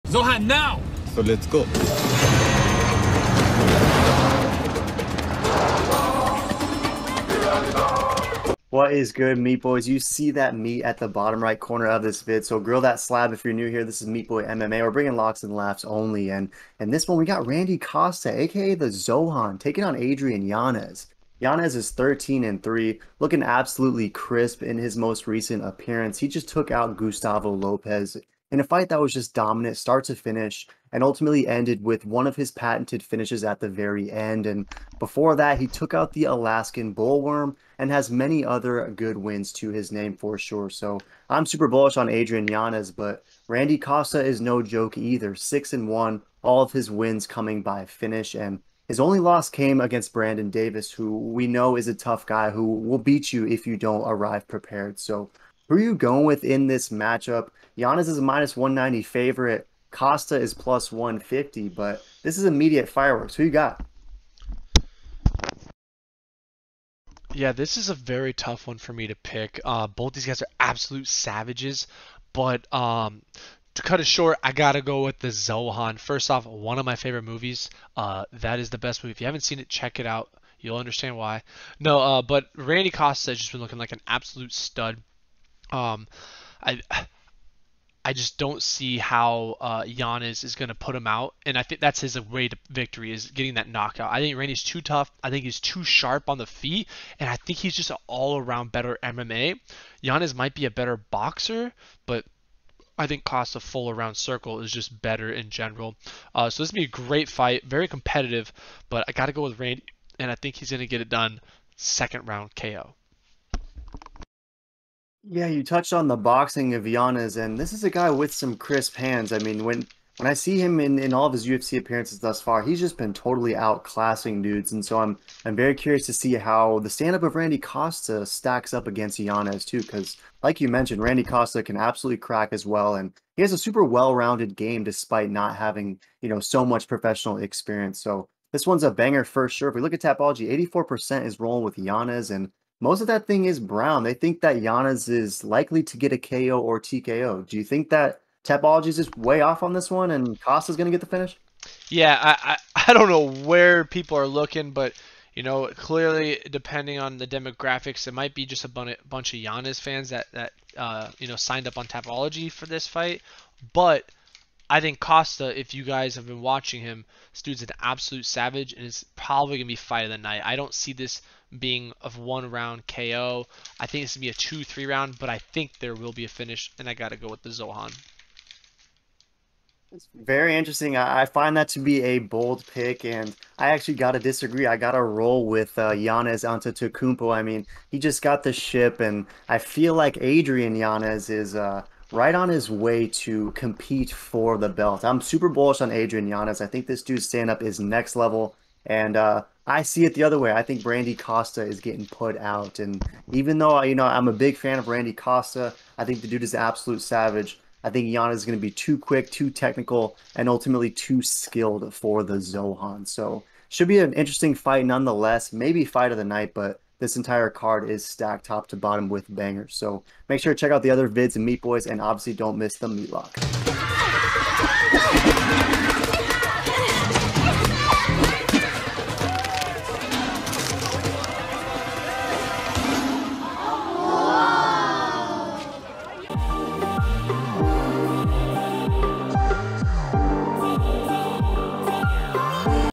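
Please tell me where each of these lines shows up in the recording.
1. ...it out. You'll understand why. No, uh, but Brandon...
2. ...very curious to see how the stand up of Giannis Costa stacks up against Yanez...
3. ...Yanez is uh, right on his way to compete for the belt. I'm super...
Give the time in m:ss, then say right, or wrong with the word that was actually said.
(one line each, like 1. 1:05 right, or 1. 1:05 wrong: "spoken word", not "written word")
1. 1:19 wrong: "Randy", not "Brandon"
2. 2:05 wrong: "Randy", not "Giannis"
3. 3:10 right.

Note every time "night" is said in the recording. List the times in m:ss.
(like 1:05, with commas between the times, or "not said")
2:50, 3:36.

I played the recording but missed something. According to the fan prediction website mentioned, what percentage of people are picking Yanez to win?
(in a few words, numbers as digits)
84%.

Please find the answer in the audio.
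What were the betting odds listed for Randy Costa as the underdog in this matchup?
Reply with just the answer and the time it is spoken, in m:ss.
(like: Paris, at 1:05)
+150, at 1:00.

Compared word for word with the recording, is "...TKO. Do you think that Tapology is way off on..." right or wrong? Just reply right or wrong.
right.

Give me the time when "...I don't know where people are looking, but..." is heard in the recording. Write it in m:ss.
2:32.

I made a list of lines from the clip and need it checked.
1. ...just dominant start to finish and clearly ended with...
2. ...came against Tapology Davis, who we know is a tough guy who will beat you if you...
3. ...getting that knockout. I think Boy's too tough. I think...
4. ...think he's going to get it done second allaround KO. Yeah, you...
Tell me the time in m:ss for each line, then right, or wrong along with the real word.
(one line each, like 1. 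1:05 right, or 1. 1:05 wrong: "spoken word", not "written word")
1. 0:29 wrong: "ultimately", not "clearly"
2. 0:49 wrong: "Brandon", not "Tapology"
3. 1:33 wrong: "Randy", not "Boy"
4. 1:50 wrong: "round", not "allaround".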